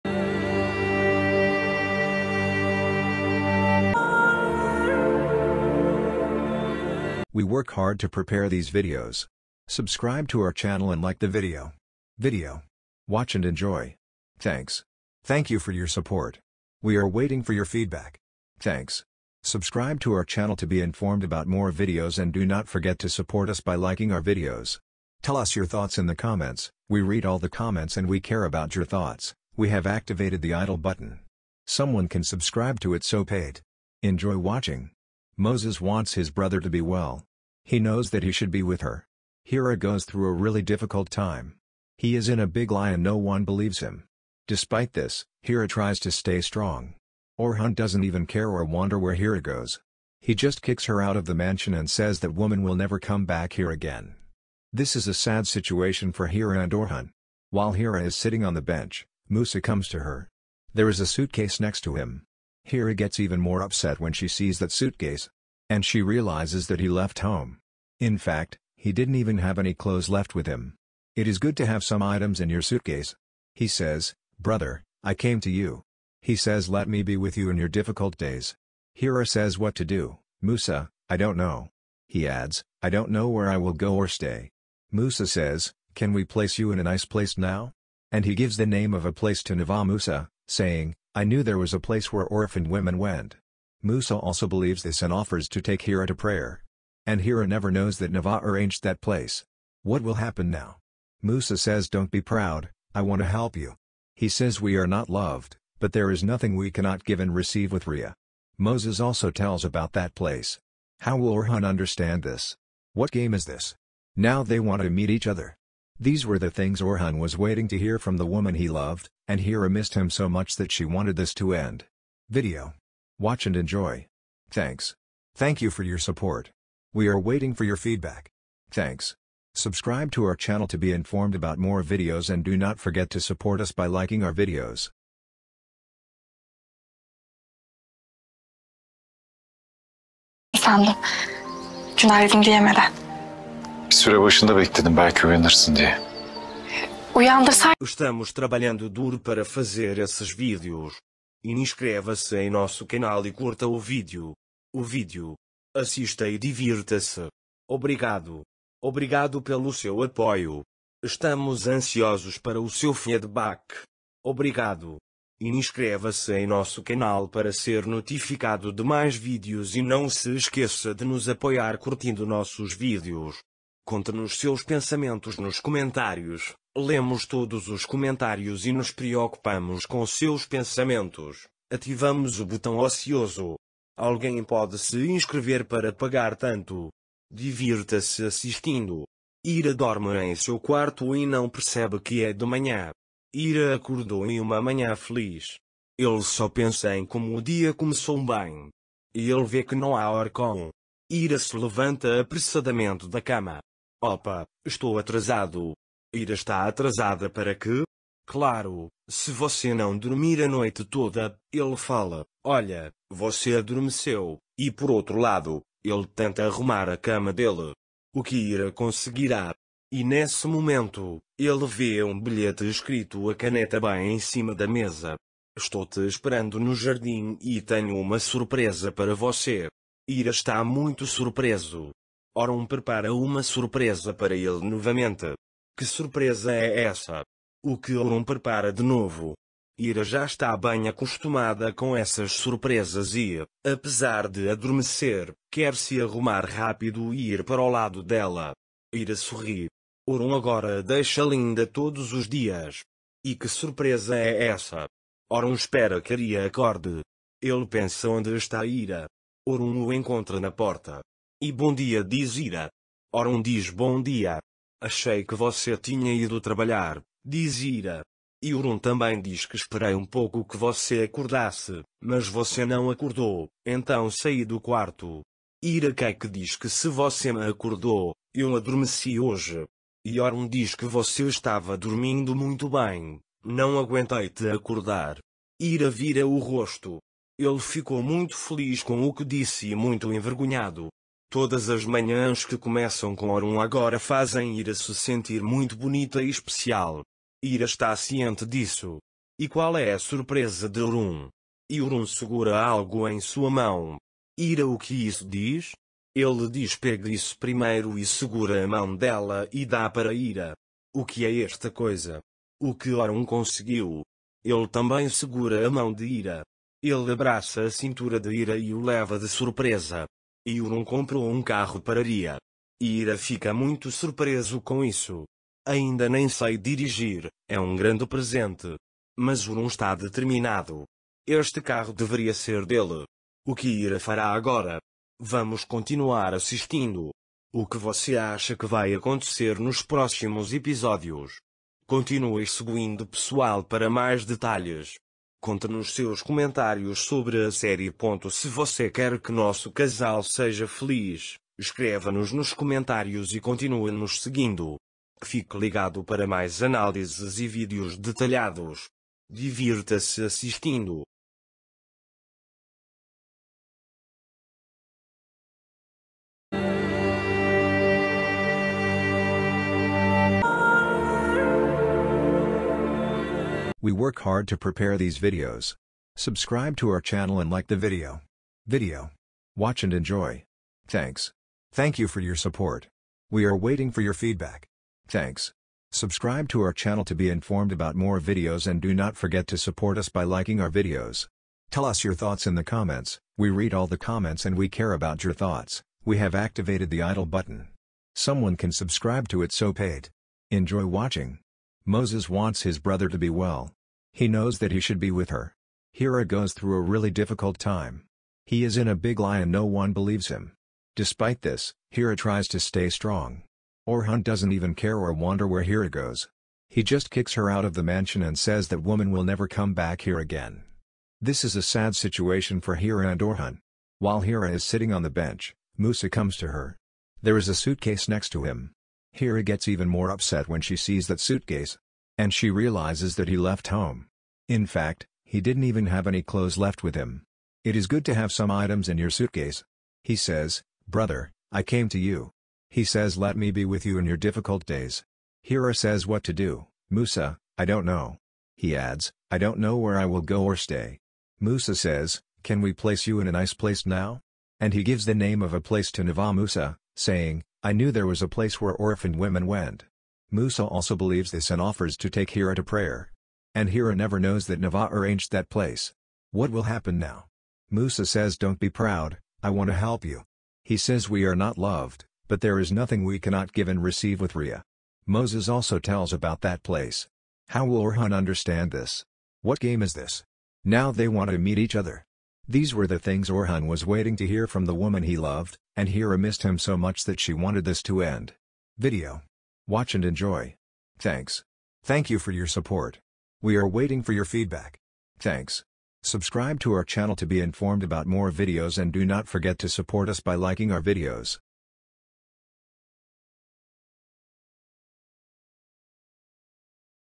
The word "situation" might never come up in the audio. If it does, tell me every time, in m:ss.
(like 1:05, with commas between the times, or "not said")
0:55, 7:01.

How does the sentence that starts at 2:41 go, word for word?
Estamos ansiosos para o seu feedback.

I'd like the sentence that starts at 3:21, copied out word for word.
Ira se levanta apressadamente da cama.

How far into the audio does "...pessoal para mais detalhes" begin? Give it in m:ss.
5:43.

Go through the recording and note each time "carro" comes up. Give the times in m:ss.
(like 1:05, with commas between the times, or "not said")
5:21, 5:31.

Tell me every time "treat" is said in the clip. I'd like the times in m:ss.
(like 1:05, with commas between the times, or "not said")
not said.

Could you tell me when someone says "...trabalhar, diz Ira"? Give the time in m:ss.
4:26.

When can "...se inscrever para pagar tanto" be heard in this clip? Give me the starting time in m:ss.
3:04.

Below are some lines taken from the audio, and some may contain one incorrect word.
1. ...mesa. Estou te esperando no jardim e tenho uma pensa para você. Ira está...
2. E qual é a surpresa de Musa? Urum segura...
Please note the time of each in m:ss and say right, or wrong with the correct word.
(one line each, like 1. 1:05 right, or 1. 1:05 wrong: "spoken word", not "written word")
1. 3:44 wrong: "surpresa", not "pensa"
2. 4:59 wrong: "Urum", not "Musa".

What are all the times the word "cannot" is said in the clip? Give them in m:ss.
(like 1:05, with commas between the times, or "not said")
1:46, 7:53.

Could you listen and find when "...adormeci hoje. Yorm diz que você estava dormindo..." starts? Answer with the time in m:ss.
4:38.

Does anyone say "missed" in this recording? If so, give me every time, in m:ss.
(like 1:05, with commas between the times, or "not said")
1:59, 8:06.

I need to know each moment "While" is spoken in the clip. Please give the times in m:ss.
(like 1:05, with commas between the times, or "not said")
0:57, 7:03.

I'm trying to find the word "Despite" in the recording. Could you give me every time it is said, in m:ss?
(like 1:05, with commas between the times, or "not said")
0:44, 6:50.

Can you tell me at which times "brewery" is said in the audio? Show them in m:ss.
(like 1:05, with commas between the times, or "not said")
not said.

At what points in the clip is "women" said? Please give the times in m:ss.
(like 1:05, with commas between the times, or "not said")
1:32, 7:39.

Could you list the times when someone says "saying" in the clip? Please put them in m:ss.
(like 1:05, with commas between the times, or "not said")
1:30, 7:36.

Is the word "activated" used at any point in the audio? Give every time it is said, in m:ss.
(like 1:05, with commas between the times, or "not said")
0:29, 6:36.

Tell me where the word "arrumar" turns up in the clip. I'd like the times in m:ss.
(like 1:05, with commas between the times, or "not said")
3:36, 4:06.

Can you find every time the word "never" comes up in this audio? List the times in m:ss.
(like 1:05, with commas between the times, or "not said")
0:52, 1:37, 6:59, 7:43.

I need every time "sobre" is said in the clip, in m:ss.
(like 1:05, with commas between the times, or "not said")
5:47.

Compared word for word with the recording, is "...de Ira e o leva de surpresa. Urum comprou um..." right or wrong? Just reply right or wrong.
right.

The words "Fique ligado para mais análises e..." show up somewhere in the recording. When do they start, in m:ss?
5:55.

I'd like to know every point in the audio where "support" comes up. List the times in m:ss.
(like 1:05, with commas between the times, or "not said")
0:15, 0:23, 2:05, 2:13, 6:22, 6:29, 8:12, 8:19.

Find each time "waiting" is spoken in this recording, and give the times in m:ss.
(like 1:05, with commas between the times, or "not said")
0:17, 1:57, 2:07, 6:23, 8:03, 8:13.